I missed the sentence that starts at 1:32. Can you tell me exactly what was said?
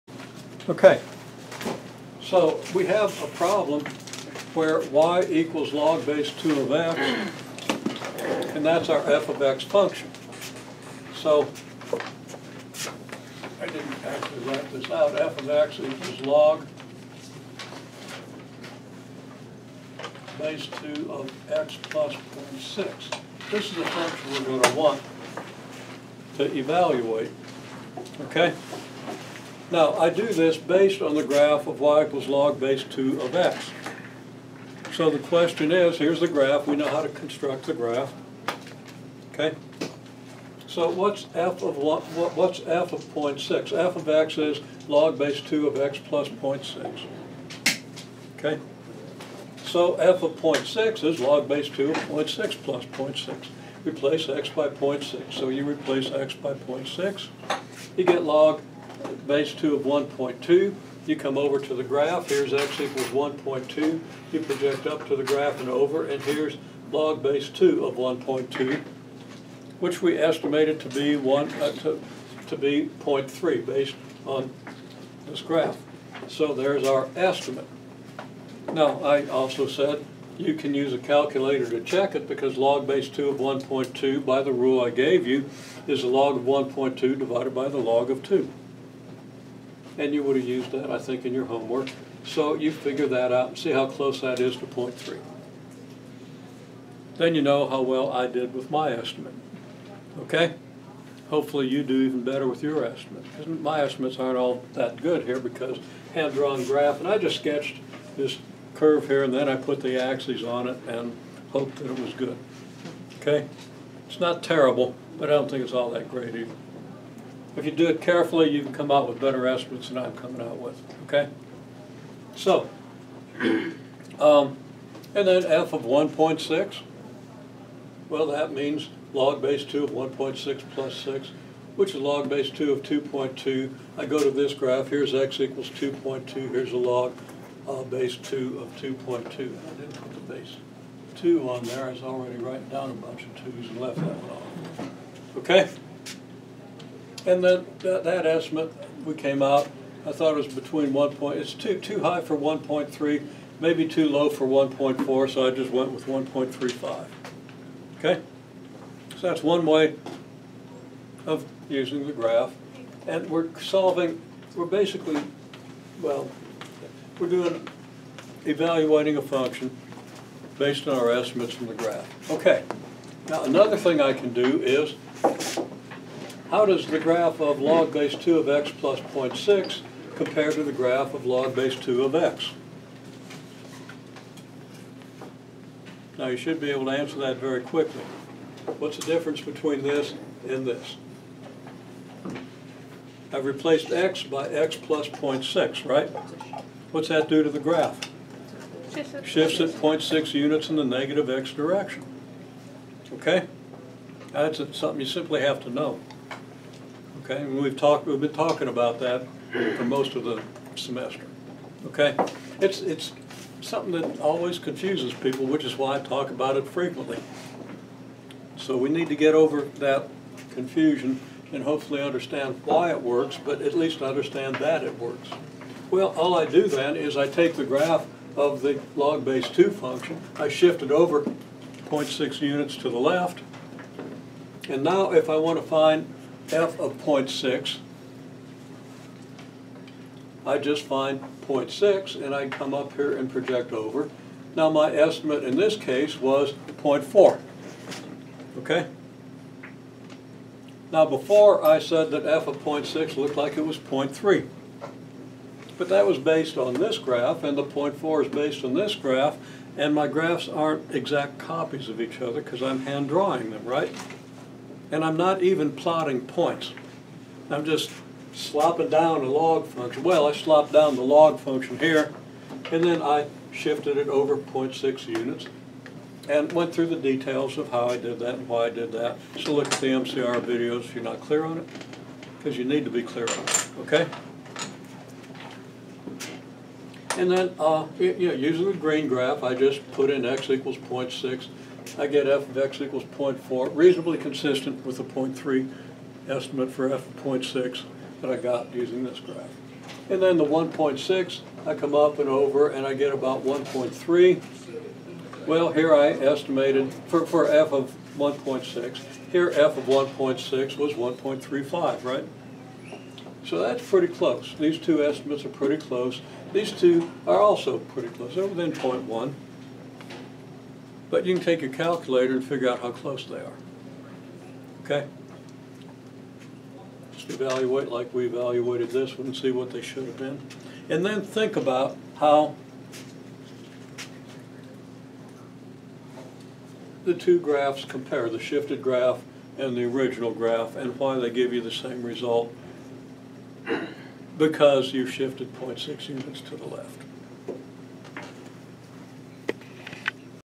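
So you figure that out and see how close that is to 0.3.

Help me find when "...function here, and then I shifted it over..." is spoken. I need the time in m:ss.
4:31.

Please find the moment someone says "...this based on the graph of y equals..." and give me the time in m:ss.
0:30.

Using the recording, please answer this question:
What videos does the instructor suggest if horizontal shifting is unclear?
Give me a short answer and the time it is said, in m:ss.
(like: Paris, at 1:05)
MCR videos, at 4:39.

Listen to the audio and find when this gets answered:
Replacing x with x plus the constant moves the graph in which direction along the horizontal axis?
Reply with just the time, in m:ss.
3:20.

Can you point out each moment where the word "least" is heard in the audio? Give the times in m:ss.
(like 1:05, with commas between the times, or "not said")
3:43.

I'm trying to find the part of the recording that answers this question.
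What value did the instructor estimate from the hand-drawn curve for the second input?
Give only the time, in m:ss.
2:36.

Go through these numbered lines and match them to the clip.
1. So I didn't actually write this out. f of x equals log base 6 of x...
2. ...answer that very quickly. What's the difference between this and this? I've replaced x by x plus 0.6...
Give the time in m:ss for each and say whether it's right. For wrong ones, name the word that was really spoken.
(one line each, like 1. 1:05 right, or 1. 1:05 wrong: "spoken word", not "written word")
1. 0:11 wrong: "2", not "6"
2. 3:06 right.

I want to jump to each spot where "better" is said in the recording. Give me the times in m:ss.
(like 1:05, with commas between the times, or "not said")
1:42, 1:59.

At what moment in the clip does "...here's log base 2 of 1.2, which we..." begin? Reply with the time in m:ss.
1:06.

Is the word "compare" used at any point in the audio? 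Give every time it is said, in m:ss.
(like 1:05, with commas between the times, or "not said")
3:00, 5:37.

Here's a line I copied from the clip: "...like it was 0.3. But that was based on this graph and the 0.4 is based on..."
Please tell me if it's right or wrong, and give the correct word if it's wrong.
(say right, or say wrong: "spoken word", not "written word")
right.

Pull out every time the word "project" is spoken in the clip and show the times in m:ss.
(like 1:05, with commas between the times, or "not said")
1:04, 4:03.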